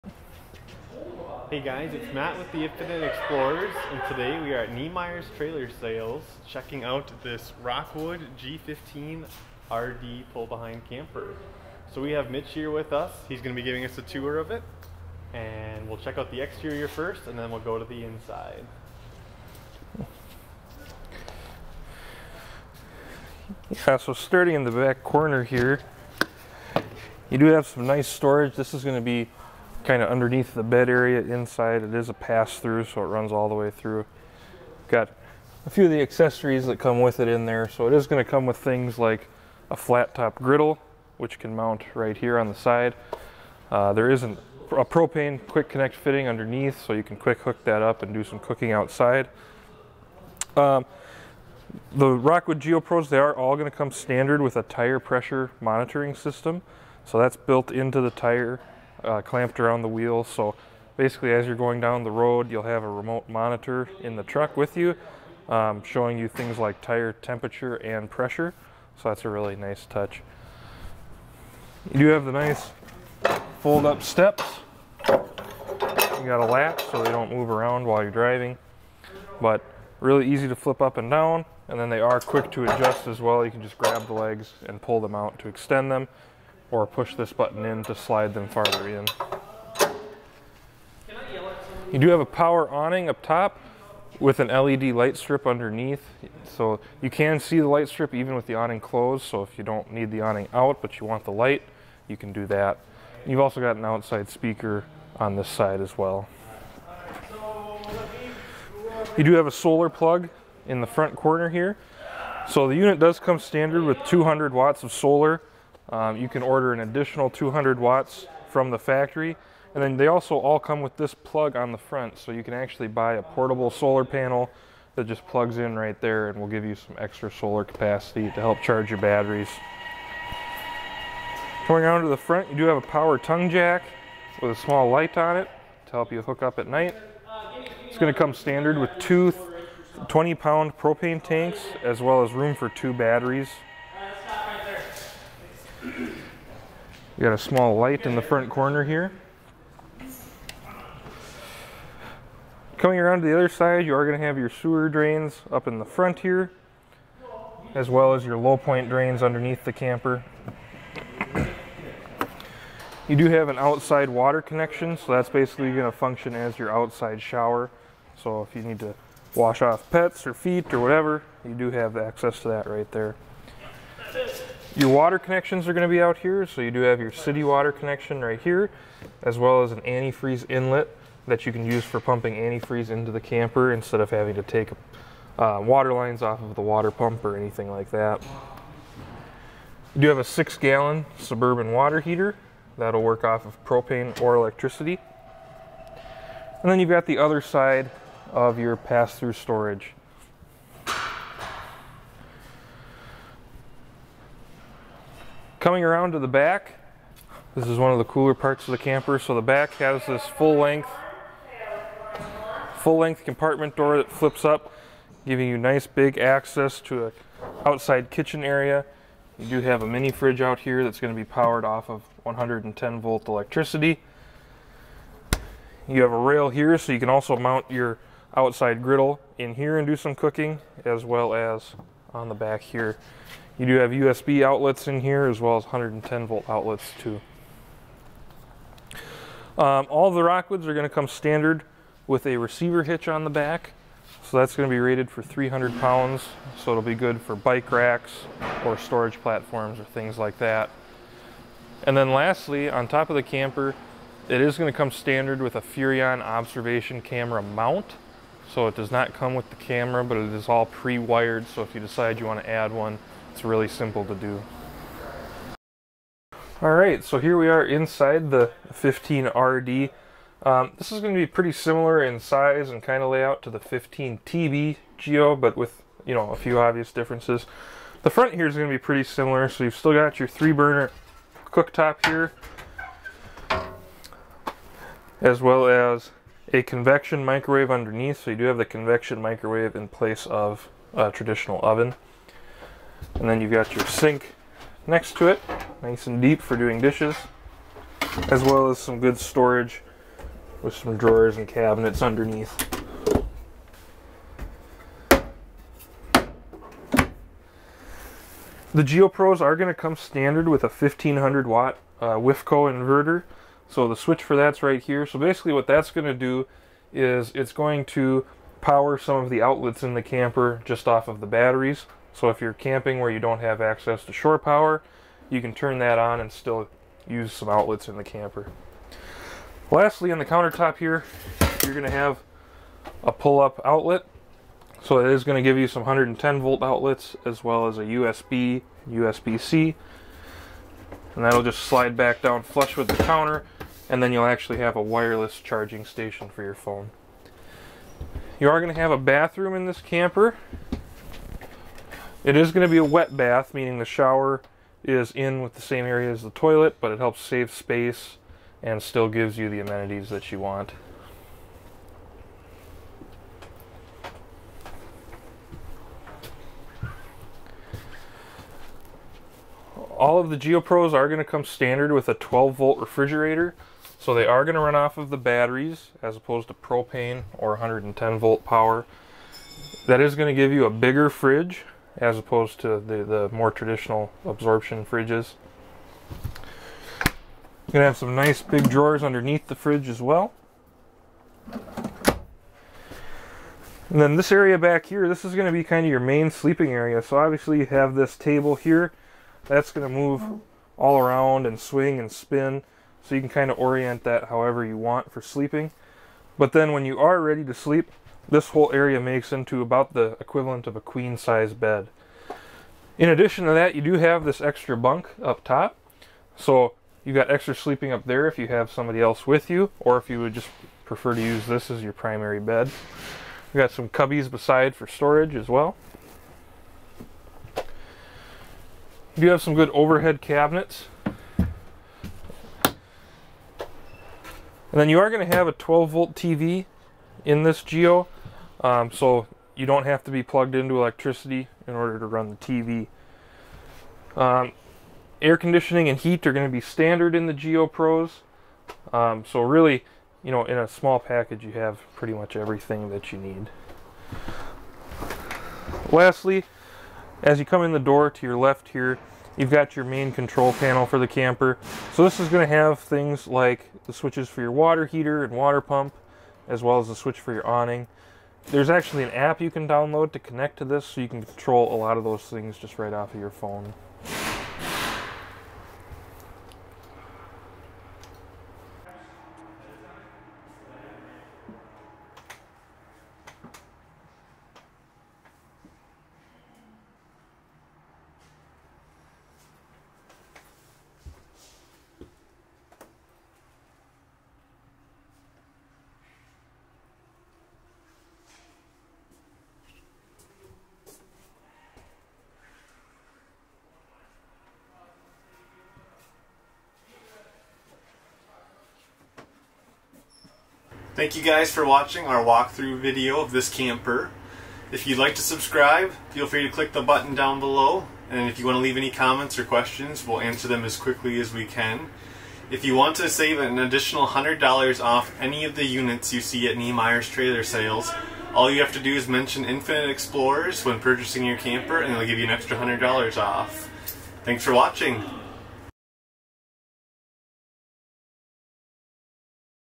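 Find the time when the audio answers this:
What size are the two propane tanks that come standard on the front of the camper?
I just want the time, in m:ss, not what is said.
2:20.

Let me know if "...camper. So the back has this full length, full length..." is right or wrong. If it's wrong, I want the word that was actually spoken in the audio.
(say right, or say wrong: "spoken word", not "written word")
right.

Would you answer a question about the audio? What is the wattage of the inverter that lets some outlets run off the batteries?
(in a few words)
1500 watt.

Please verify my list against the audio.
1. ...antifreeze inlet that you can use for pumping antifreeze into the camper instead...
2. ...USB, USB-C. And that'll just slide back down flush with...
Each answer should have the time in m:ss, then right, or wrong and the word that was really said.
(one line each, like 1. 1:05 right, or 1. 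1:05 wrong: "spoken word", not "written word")
1. 2:59 right
2. 5:37 right.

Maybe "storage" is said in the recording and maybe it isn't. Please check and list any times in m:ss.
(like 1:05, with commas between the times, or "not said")
0:28, 3:19, 4:08, 4:59, 7:04.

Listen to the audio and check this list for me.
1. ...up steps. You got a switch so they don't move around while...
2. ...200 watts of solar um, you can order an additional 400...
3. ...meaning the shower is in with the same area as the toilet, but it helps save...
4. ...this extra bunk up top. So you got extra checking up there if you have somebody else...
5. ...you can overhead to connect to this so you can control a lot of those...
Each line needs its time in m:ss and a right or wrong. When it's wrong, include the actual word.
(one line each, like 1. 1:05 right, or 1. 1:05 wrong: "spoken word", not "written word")
1. 1:13 wrong: "latch", not "switch"
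2. 1:54 wrong: "200", not "400"
3. 5:53 right
4. 6:54 wrong: "sleeping", not "checking"
5. 7:49 wrong: "download", not "overhead".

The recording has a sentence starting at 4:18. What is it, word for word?
So it does not come with the camera, but it is all pre-wired.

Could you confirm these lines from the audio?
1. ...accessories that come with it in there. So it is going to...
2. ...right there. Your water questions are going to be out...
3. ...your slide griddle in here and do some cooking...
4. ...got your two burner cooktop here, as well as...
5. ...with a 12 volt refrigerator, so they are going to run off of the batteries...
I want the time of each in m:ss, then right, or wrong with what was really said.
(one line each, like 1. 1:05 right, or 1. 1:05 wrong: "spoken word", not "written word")
1. 0:35 right
2. 2:52 wrong: "connections", not "questions"
3. 3:47 wrong: "outside", not "slide"
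4. 4:39 wrong: "three", not "two"
5. 6:11 right.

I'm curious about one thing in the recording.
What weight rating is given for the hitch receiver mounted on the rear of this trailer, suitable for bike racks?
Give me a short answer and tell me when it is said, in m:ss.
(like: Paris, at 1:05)
300 pounds, at 4:05.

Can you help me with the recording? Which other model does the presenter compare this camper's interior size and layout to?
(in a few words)
15TB Geo.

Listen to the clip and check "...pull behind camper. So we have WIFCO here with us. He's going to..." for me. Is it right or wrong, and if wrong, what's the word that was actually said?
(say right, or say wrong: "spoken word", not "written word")
wrong: "Mitch", not "WIFCO".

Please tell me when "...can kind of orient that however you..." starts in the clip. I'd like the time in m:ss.
6:43.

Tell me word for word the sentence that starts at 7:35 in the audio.
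Lastly, as you come in the door to your left here, you've got your main control panel for the camper.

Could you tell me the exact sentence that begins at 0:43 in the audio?
Uh, there is isn't a propane quick connect fitting underneath, so you can quick hook that up and do some cooking outside.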